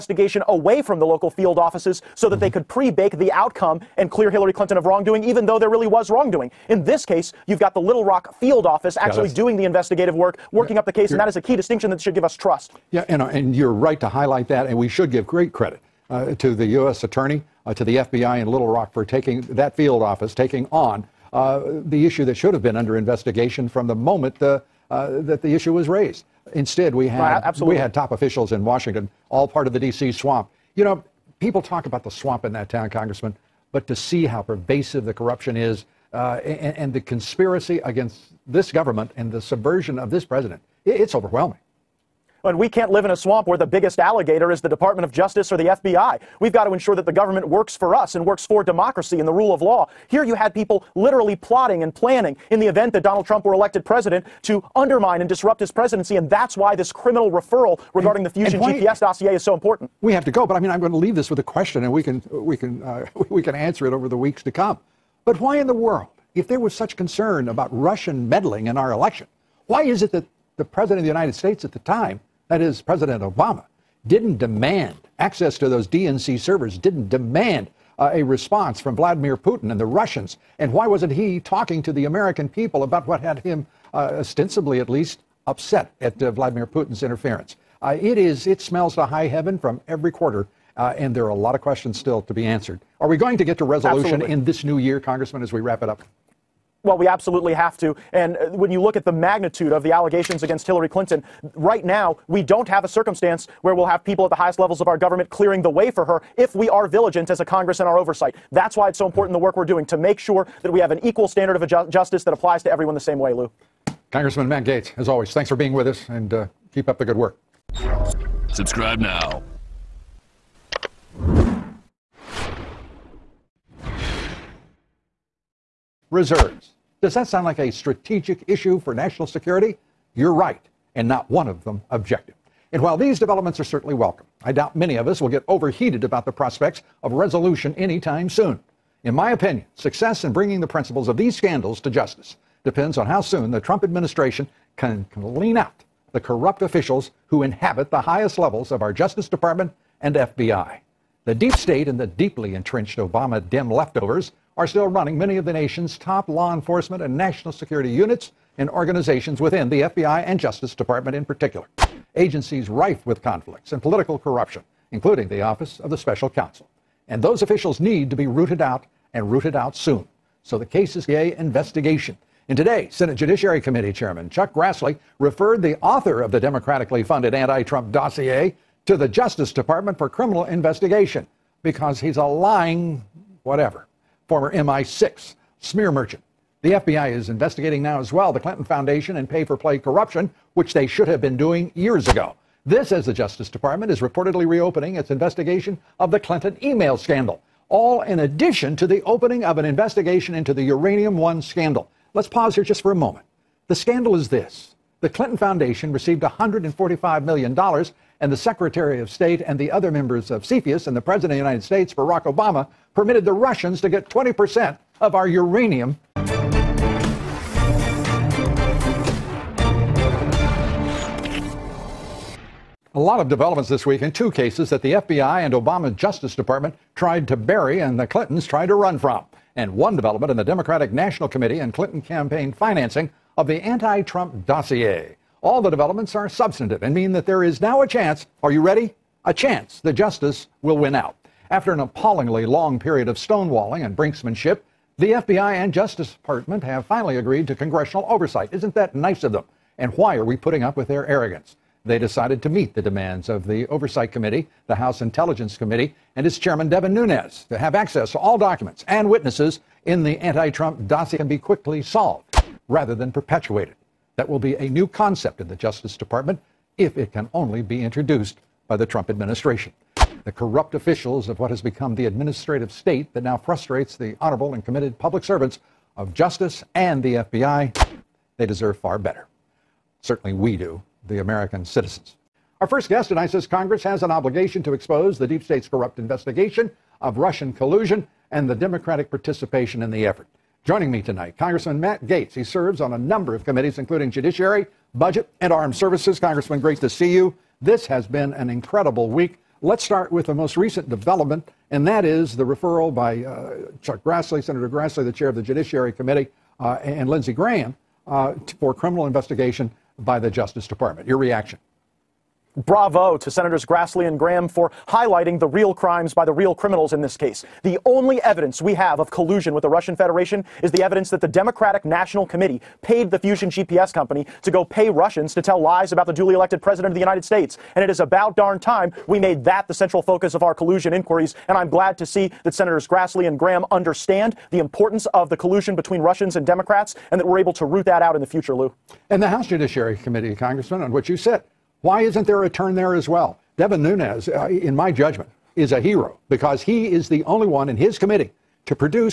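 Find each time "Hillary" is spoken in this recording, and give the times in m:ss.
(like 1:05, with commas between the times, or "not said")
0:04, 1:40.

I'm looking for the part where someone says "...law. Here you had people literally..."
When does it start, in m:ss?
0:49.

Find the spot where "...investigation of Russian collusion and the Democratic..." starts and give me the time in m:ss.
4:45.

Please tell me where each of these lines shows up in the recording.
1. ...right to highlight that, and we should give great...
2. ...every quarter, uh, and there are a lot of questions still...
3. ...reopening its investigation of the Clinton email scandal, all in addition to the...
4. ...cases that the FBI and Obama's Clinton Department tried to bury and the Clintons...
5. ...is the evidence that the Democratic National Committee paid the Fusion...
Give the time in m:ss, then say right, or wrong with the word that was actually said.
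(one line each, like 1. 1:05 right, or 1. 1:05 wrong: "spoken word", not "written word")
1. 0:13 right
2. 1:29 right
3. 3:14 right
4. 3:44 wrong: "Justice", not "Clinton"
5. 5:20 right.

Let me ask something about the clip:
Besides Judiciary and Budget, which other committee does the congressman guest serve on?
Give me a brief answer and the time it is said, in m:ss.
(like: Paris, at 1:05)
Armed Services, at 4:55.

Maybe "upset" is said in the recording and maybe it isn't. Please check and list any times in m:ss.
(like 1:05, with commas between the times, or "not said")
1:25.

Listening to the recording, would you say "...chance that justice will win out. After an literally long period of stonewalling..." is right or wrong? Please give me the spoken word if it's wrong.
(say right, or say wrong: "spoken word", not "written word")
wrong: "appallingly", not "literally".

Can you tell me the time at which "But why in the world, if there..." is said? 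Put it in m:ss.
1:05.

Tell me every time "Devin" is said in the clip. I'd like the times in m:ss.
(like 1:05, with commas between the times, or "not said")
4:16, 5:43.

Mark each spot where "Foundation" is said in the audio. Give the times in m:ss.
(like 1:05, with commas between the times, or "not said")
3:08, 3:25.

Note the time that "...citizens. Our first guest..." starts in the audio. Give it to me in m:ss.
4:41.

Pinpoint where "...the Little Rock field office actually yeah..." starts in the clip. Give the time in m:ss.
0:07.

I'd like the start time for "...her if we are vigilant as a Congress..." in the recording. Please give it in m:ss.
1:46.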